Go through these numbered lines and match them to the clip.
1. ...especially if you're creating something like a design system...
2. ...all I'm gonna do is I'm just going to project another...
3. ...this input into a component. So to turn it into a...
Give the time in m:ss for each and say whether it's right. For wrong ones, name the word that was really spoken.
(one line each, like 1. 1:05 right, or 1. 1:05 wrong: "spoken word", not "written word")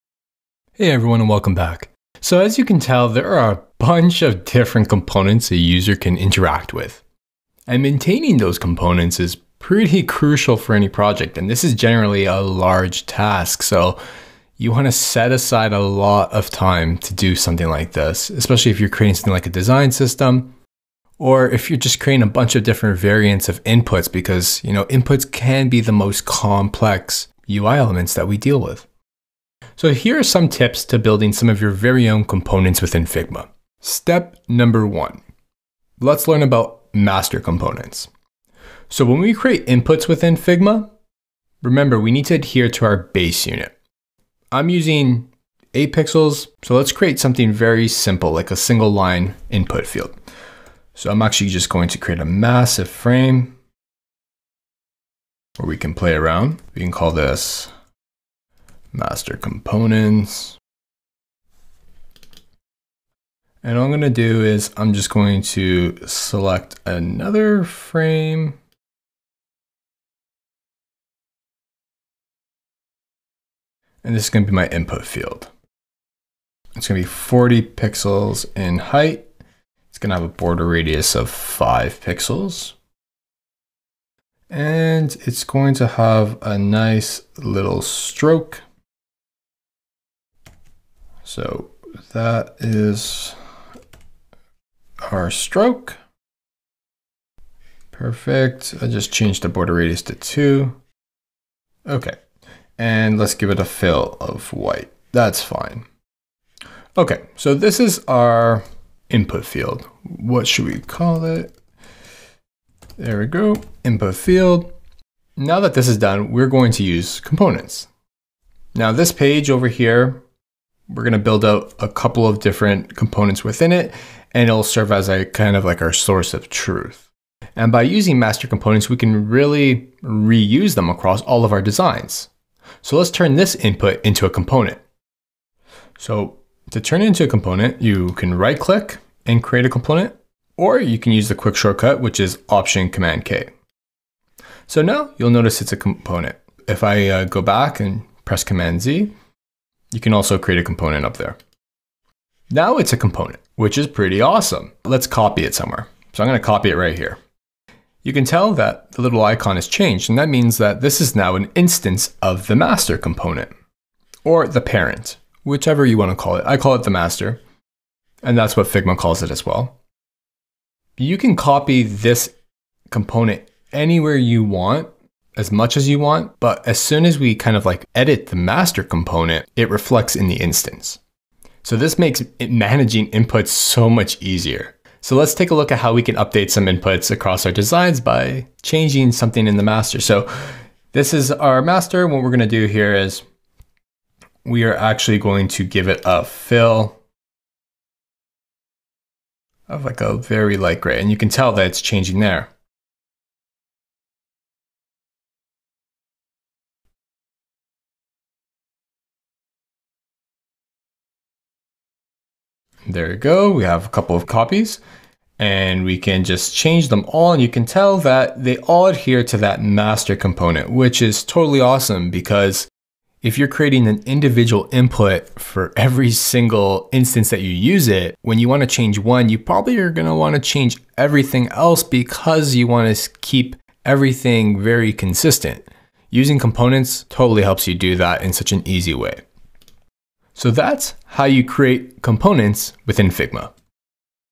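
1. 0:18 right
2. 1:03 wrong: "select", not "project"
3. 2:13 right.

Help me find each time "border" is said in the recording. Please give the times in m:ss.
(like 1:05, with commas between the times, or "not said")
1:20, 1:39.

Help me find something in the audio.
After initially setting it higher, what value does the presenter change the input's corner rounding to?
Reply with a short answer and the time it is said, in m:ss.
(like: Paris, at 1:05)
2, at 1:40.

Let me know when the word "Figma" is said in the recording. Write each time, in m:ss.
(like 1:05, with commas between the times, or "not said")
0:33, 0:40, 2:48, 4:03.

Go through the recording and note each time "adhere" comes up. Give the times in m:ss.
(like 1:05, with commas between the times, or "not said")
0:42, 3:38.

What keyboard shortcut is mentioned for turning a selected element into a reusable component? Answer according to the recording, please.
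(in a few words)
Option Command K.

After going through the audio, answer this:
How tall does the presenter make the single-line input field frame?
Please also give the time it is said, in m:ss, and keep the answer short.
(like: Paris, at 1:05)
40 pixels, at 1:17.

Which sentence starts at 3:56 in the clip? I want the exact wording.
Using components totally helps you do that in such an easy way.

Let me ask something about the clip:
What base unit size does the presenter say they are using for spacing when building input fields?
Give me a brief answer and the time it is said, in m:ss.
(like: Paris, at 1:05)
8 pixels, at 0:45.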